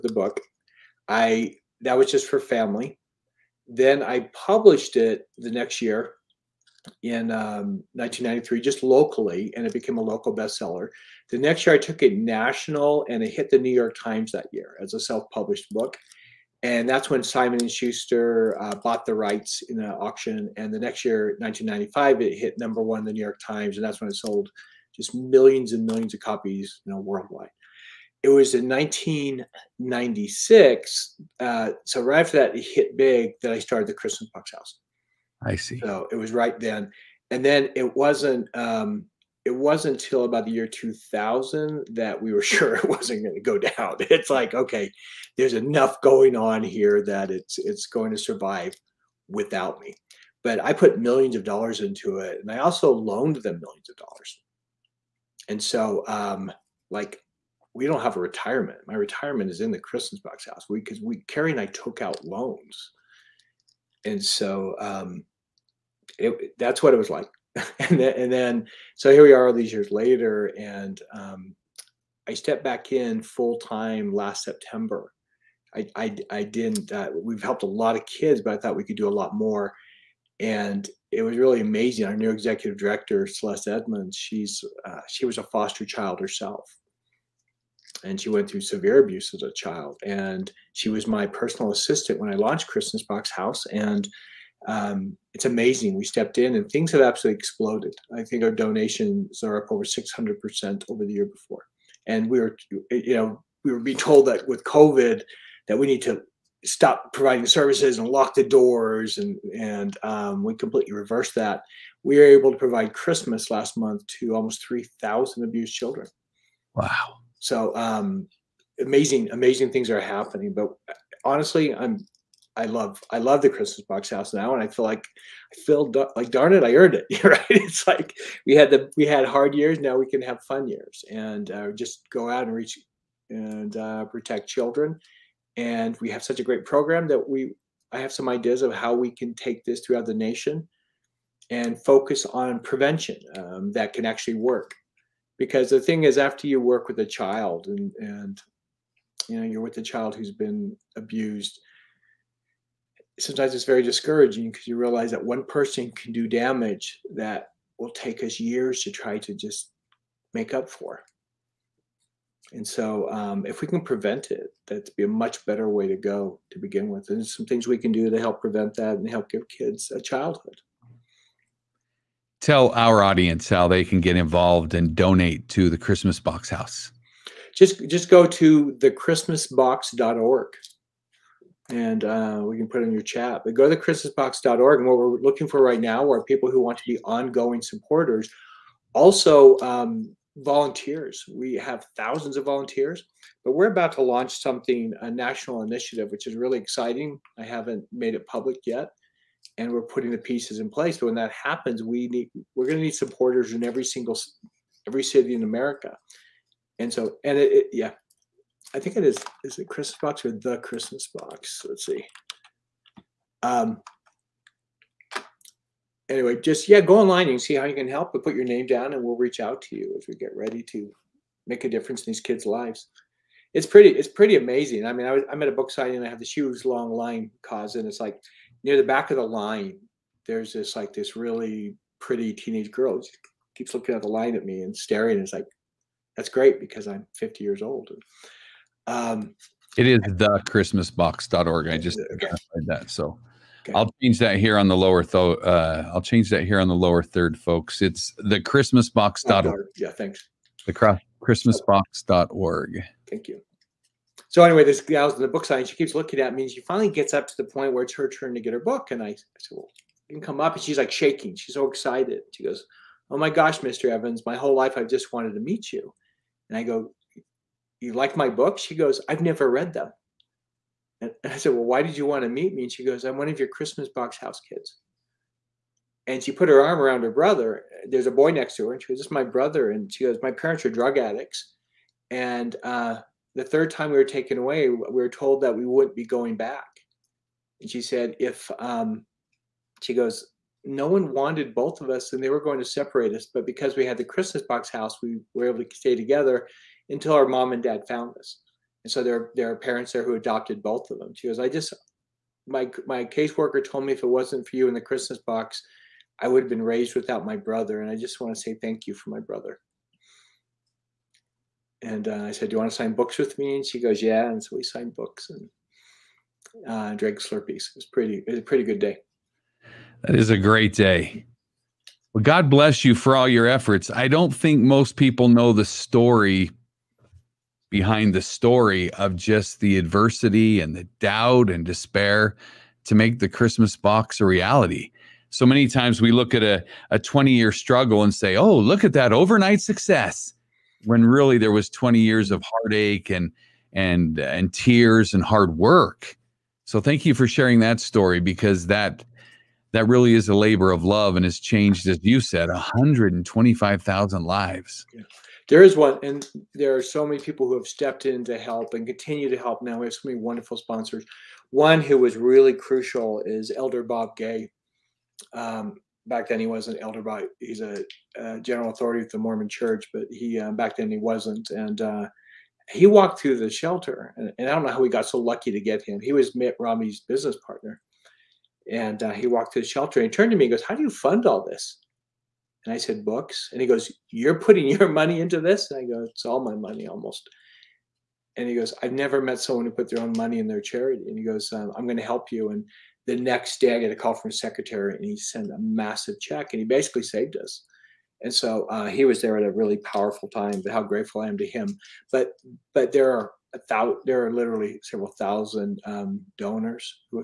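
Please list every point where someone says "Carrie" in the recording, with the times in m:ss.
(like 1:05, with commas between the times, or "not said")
1:01.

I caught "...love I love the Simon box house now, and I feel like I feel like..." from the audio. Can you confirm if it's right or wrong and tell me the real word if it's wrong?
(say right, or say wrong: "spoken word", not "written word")
wrong: "Christmas", not "Simon".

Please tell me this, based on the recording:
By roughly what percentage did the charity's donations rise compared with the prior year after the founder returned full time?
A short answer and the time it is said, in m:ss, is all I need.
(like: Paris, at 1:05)
600%, at 1:39.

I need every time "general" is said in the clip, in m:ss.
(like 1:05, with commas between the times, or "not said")
6:08.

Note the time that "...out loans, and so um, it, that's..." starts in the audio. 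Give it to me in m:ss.
1:02.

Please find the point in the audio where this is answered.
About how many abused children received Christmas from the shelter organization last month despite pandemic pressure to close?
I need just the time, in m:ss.
1:54.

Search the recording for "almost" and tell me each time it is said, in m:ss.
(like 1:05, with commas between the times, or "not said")
1:54, 6:26.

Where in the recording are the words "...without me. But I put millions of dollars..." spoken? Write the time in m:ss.
0:49.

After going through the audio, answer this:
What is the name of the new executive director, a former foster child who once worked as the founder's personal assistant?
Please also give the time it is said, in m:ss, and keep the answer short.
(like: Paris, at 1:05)
Celeste Edmonds, at 1:23.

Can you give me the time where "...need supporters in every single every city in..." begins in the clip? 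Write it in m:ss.
3:22.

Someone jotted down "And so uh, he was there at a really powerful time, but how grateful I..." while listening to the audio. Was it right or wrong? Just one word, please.
right.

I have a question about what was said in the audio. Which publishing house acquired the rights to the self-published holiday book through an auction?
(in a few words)
Simon and Schuster.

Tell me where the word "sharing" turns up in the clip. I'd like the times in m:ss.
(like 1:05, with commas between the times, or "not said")
5:47.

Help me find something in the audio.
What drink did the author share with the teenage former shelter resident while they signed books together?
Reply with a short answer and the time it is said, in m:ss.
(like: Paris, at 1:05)
Slurpees, at 5:17.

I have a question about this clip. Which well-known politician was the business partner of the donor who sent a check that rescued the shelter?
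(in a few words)
Mitt Romney.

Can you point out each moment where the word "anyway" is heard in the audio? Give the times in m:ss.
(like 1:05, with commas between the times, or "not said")
3:36, 4:14.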